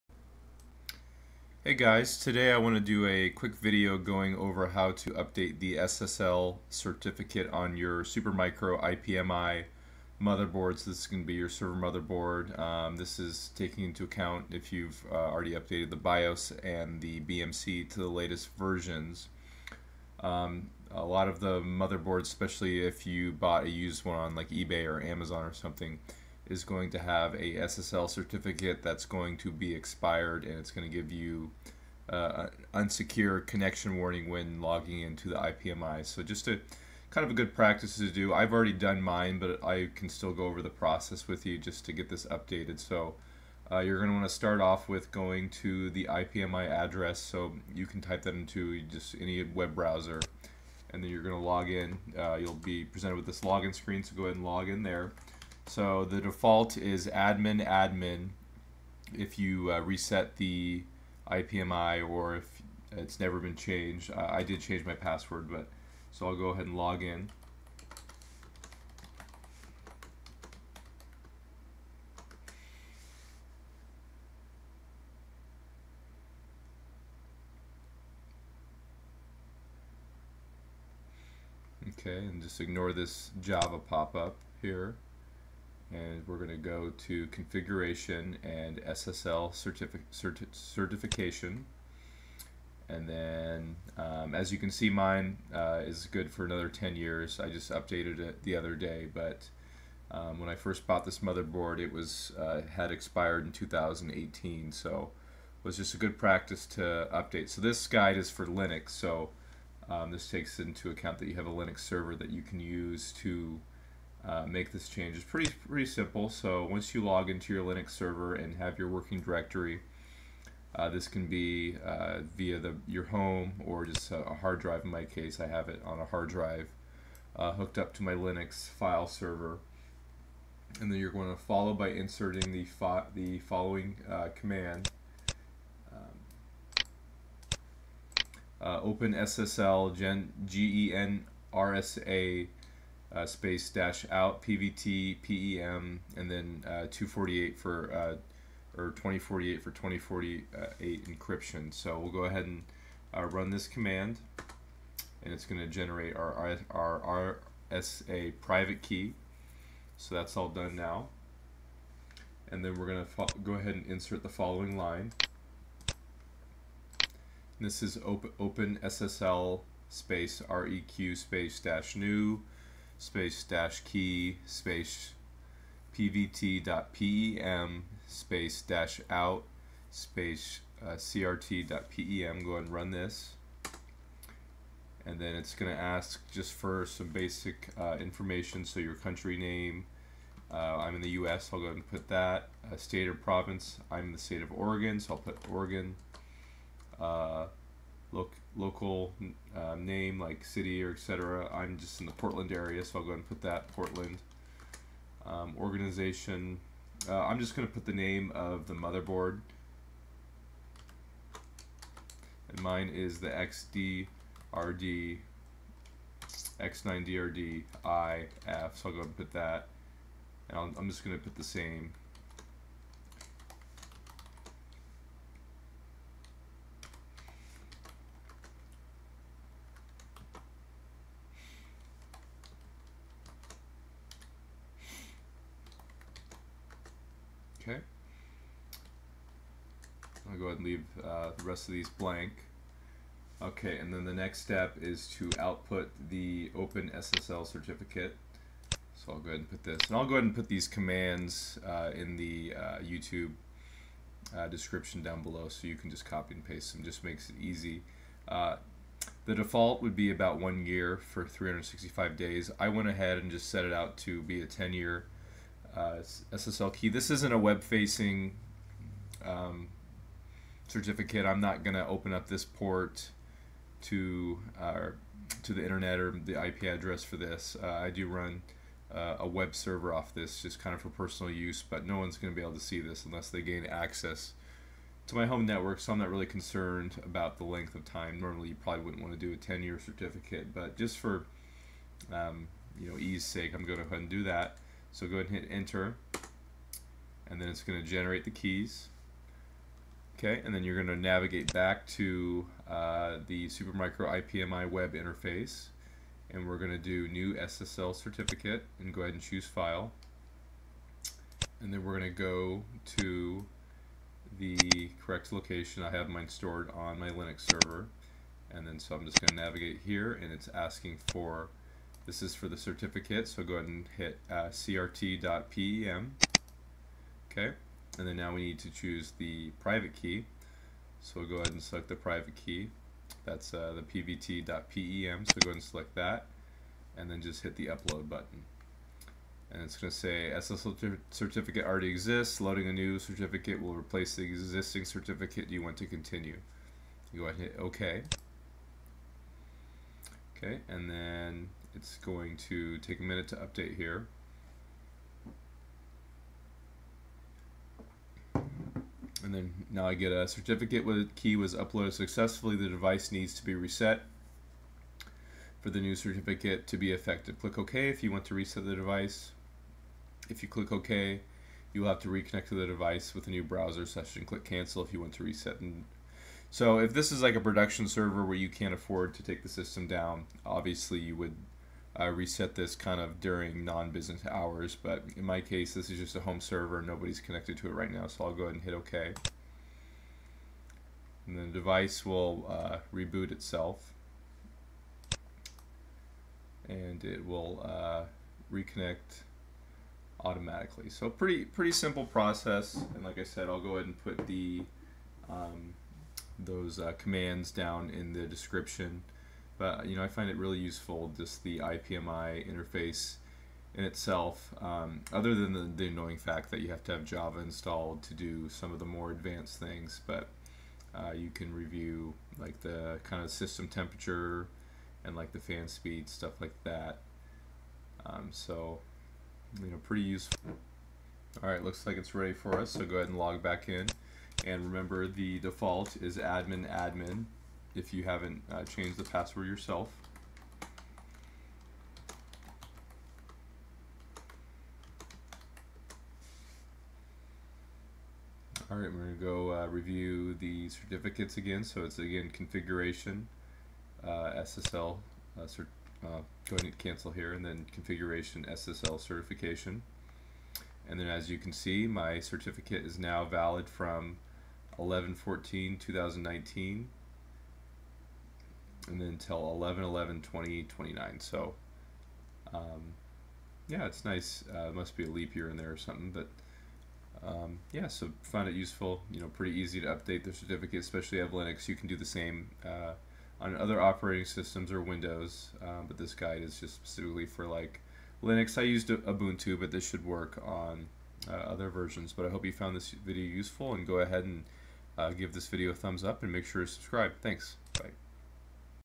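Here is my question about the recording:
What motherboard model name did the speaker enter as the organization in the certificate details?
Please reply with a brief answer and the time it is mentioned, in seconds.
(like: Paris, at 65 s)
X9DRDI, at 216 s.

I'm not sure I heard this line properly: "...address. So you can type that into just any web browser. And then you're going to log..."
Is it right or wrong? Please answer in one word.
right.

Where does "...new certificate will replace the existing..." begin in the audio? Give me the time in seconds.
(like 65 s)
342 s.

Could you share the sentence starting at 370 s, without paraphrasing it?
If you click OK, you will have to reconnect to the device with a new browser session.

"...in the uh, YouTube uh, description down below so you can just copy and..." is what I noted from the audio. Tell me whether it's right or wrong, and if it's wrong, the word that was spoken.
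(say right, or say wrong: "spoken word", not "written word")
right.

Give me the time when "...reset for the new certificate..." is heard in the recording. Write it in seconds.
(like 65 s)
363 s.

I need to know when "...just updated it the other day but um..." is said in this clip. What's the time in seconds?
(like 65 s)
97 s.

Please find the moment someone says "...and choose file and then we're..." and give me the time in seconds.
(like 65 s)
309 s.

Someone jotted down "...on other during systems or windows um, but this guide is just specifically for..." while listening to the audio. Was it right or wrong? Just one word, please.
wrong.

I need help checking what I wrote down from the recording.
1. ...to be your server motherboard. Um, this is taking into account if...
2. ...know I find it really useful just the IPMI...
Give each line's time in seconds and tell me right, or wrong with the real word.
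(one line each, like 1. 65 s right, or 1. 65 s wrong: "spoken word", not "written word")
1. 11 s right
2. 409 s right.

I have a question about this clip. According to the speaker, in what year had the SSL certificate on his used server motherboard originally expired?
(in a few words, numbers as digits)
2018.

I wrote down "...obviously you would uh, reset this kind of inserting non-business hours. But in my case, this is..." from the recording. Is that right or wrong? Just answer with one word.
wrong.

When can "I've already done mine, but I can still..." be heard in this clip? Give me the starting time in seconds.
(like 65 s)
38 s.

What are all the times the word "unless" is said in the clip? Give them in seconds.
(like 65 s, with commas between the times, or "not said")
283 s.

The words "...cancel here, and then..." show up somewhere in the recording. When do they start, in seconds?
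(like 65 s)
456 s.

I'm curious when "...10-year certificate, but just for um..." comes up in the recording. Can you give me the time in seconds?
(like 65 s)
289 s.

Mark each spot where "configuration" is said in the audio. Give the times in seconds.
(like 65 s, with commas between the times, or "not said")
87 s, 452 s, 457 s.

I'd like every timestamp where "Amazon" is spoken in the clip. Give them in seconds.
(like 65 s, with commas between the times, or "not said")
24 s.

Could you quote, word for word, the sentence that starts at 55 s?
So the default is admin admin if you uh, reset the IPMI or if it's never been changed.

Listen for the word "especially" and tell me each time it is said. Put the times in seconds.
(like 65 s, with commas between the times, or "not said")
22 s, 480 s.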